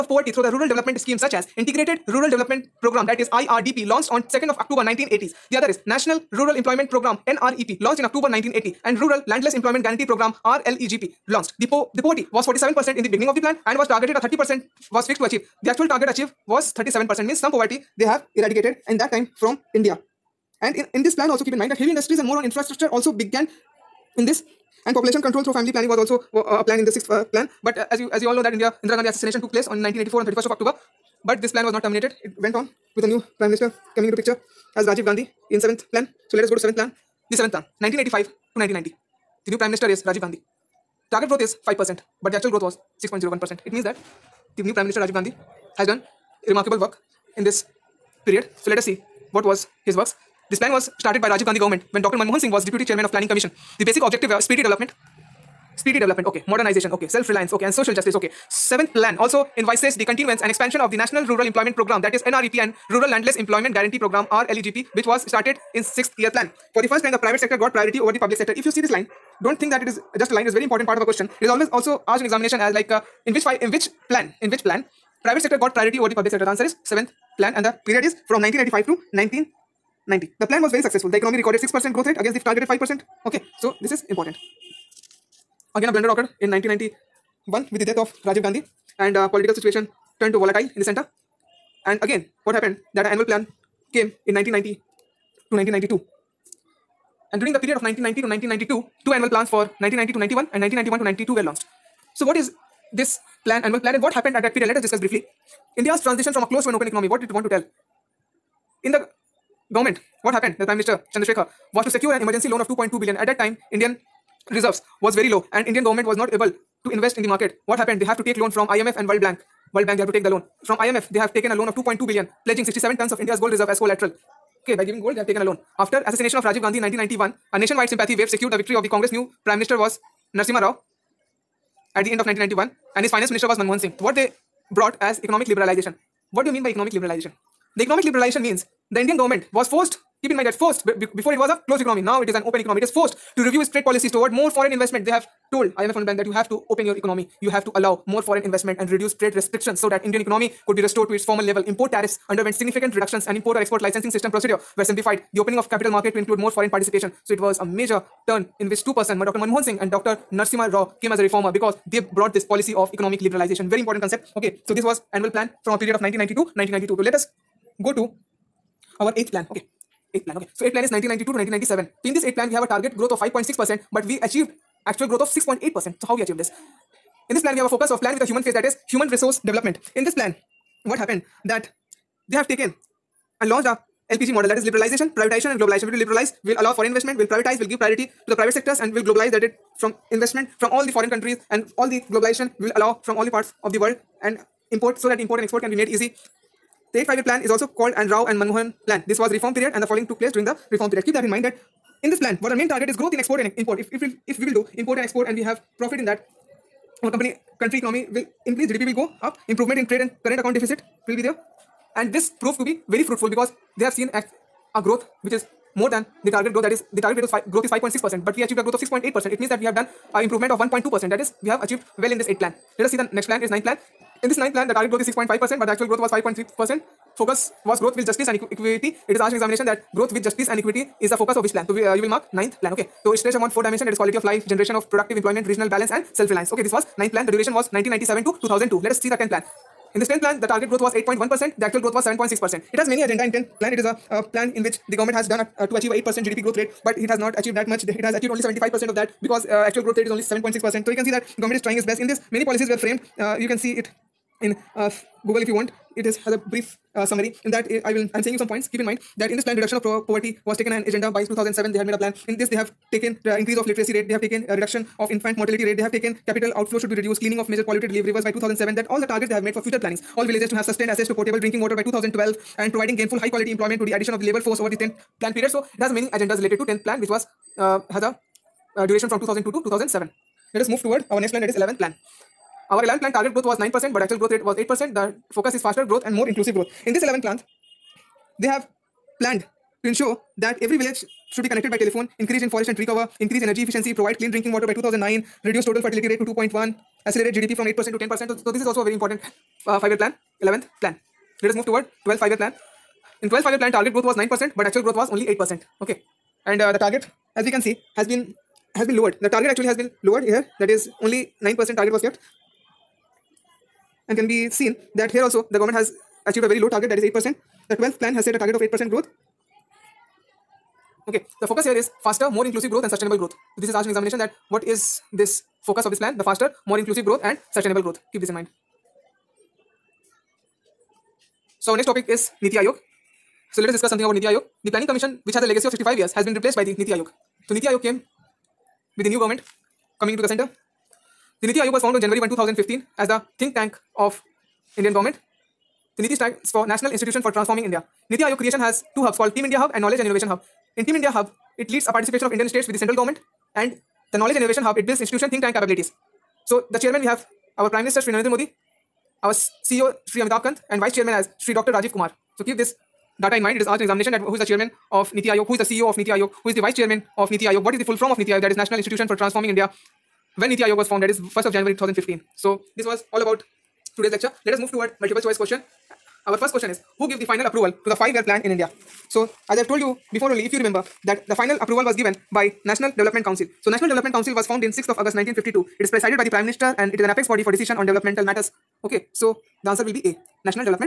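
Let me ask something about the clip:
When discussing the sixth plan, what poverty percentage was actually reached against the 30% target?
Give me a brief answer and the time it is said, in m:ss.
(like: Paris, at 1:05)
37%, at 0:16.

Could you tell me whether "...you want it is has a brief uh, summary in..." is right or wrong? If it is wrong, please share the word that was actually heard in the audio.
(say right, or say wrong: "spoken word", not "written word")
right.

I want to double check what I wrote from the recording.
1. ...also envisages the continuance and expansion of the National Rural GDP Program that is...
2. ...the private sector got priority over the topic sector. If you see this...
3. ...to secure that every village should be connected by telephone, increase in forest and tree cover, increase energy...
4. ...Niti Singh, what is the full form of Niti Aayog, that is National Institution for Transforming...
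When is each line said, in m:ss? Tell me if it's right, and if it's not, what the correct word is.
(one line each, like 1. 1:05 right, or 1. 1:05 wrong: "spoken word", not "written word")
1. 0:59 wrong: "Employment", not "GDP"
2. 1:07 wrong: "public", not "topic"
3. 4:49 wrong: "ensure", not "secure"
4. 6:07 wrong: "Aayog", not "Singh".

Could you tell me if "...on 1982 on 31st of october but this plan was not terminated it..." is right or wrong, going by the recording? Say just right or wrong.
wrong.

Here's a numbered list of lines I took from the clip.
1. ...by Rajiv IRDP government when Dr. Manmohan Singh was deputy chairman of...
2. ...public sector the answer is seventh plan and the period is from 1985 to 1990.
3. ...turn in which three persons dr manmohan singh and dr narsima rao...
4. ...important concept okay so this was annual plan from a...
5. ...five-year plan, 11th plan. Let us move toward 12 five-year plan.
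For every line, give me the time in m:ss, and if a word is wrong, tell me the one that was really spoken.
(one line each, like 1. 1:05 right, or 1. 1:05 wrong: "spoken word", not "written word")
1. 0:51 wrong: "Gandhi", not "IRDP"
2. 1:16 right
3. 2:38 wrong: "two", not "three"
4. 2:43 right
5. 4:59 right.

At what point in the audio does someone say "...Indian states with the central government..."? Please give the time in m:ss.
5:52.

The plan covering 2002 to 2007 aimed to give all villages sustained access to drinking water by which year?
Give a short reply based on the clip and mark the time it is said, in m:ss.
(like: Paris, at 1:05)
2012, at 4:31.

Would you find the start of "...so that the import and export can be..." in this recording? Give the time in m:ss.
3:14.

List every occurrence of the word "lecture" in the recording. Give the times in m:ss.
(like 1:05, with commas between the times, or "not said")
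6:14.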